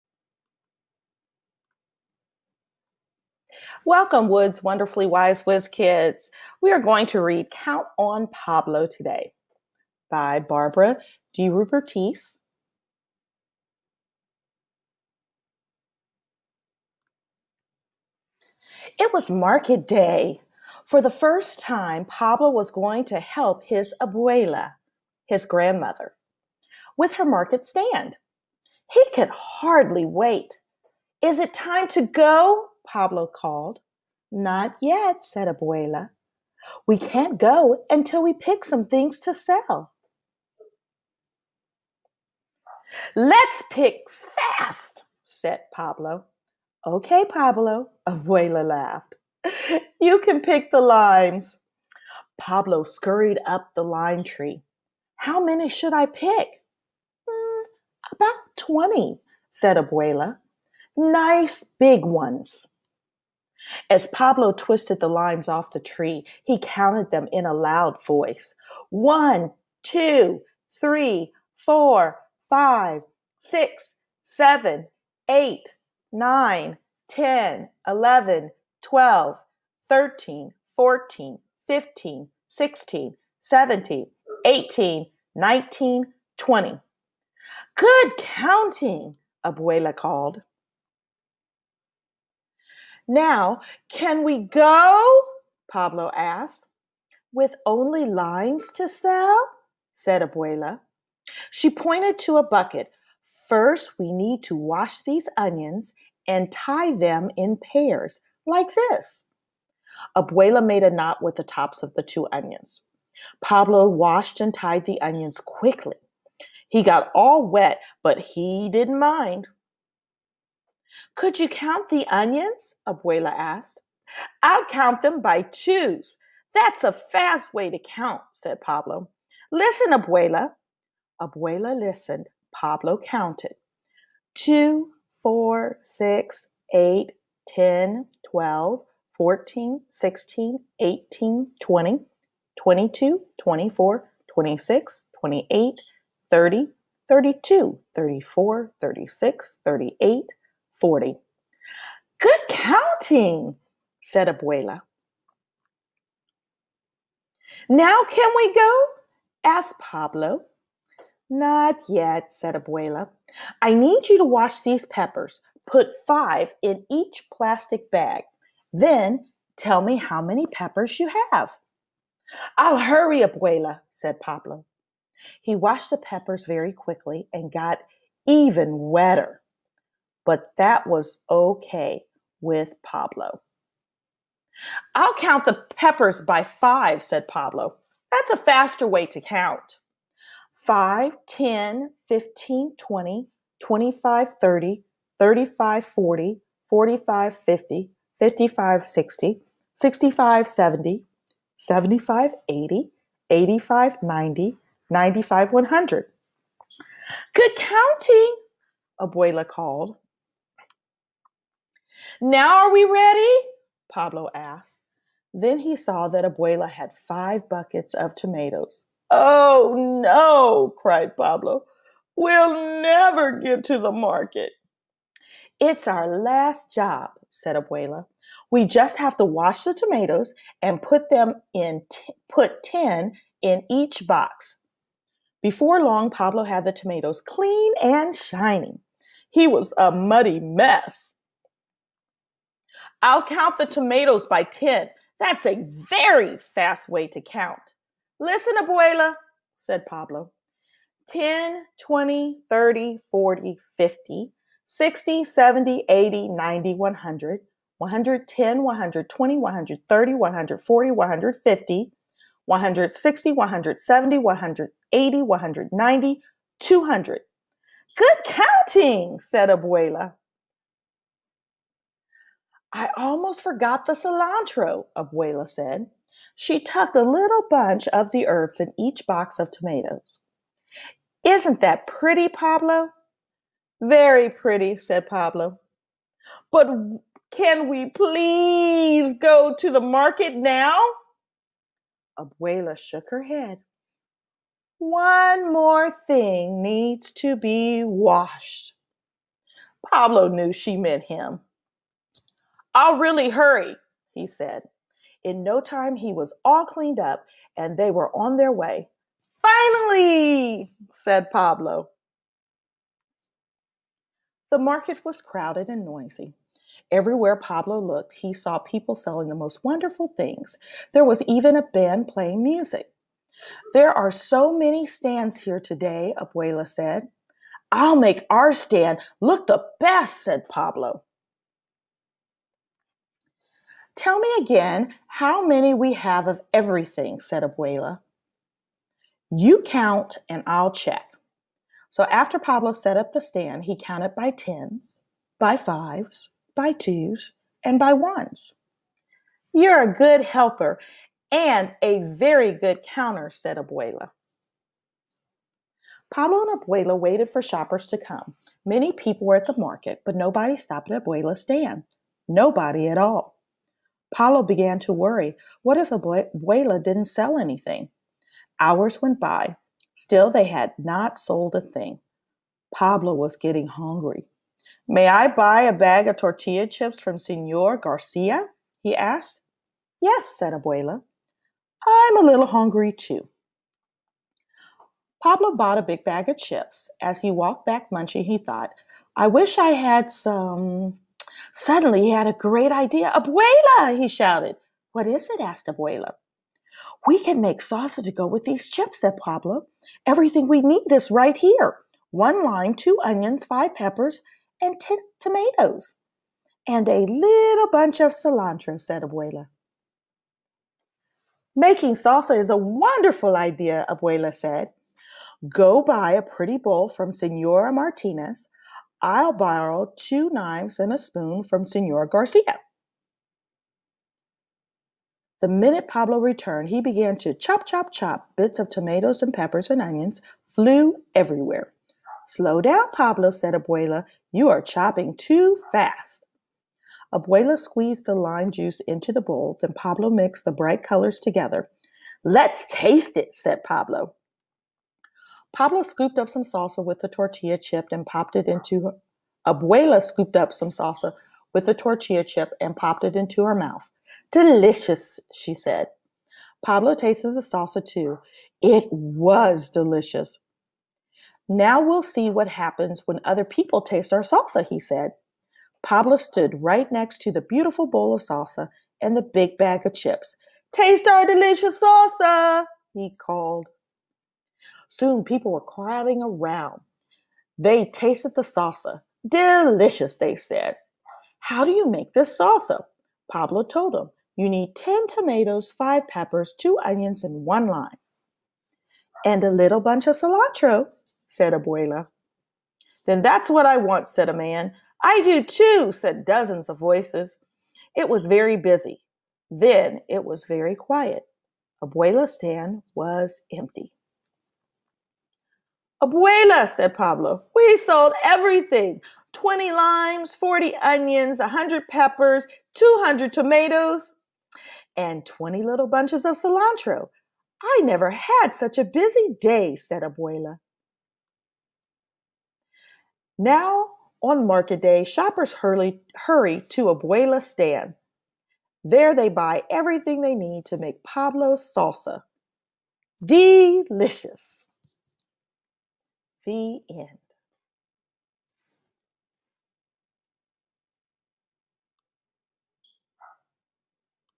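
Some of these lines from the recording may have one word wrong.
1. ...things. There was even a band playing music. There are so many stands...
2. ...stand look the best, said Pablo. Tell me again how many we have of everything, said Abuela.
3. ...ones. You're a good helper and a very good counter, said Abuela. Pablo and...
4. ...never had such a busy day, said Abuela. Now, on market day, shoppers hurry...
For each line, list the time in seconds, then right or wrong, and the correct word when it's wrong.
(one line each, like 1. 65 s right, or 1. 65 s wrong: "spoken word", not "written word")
1. 320 s right
2. 328 s right
3. 347 s right
4. 517 s right.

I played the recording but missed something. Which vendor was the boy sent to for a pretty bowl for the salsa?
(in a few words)
Senora Martinez.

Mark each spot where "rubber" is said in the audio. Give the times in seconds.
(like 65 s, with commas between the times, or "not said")
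not said.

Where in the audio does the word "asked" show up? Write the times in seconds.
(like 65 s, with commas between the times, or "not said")
96 s, 123 s, 159 s, 214 s, 378 s, 395 s.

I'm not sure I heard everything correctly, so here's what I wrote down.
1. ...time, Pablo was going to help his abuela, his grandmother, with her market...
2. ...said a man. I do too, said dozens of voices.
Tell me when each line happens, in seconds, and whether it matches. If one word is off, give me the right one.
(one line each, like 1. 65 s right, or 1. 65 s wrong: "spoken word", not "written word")
1. 21 s right
2. 494 s right.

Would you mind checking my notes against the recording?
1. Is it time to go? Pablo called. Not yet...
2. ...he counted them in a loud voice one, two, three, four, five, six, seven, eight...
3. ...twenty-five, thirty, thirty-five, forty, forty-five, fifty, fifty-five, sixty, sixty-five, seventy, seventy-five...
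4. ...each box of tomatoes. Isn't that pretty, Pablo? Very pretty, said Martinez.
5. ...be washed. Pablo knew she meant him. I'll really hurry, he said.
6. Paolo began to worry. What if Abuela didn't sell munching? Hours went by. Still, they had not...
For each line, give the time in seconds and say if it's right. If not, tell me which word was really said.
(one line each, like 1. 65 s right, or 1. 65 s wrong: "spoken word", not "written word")
1. 31 s right
2. 66 s right
3. 193 s right
4. 278 s wrong: "Pablo", not "Martinez"
5. 297 s right
6. 364 s wrong: "anything", not "munching".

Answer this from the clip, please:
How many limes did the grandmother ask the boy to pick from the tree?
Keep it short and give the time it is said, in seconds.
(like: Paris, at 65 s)
20, at 58 s.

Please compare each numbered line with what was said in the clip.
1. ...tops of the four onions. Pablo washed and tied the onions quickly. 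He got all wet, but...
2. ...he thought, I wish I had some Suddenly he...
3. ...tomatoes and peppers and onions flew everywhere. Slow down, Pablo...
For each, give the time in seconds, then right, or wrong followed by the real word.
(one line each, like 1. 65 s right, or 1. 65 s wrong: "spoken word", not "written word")
1. 111 s wrong: "two", not "four"
2. 388 s right
3. 428 s right.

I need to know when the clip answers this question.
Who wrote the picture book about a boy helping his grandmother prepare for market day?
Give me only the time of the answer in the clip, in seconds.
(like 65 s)
10 s.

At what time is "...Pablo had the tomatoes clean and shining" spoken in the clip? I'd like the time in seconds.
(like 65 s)
236 s.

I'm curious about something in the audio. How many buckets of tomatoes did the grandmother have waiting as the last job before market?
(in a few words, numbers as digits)
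5.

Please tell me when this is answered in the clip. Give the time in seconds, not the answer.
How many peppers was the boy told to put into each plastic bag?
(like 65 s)
165 s.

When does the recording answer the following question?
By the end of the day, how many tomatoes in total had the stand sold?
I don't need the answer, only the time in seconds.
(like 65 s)
512 s.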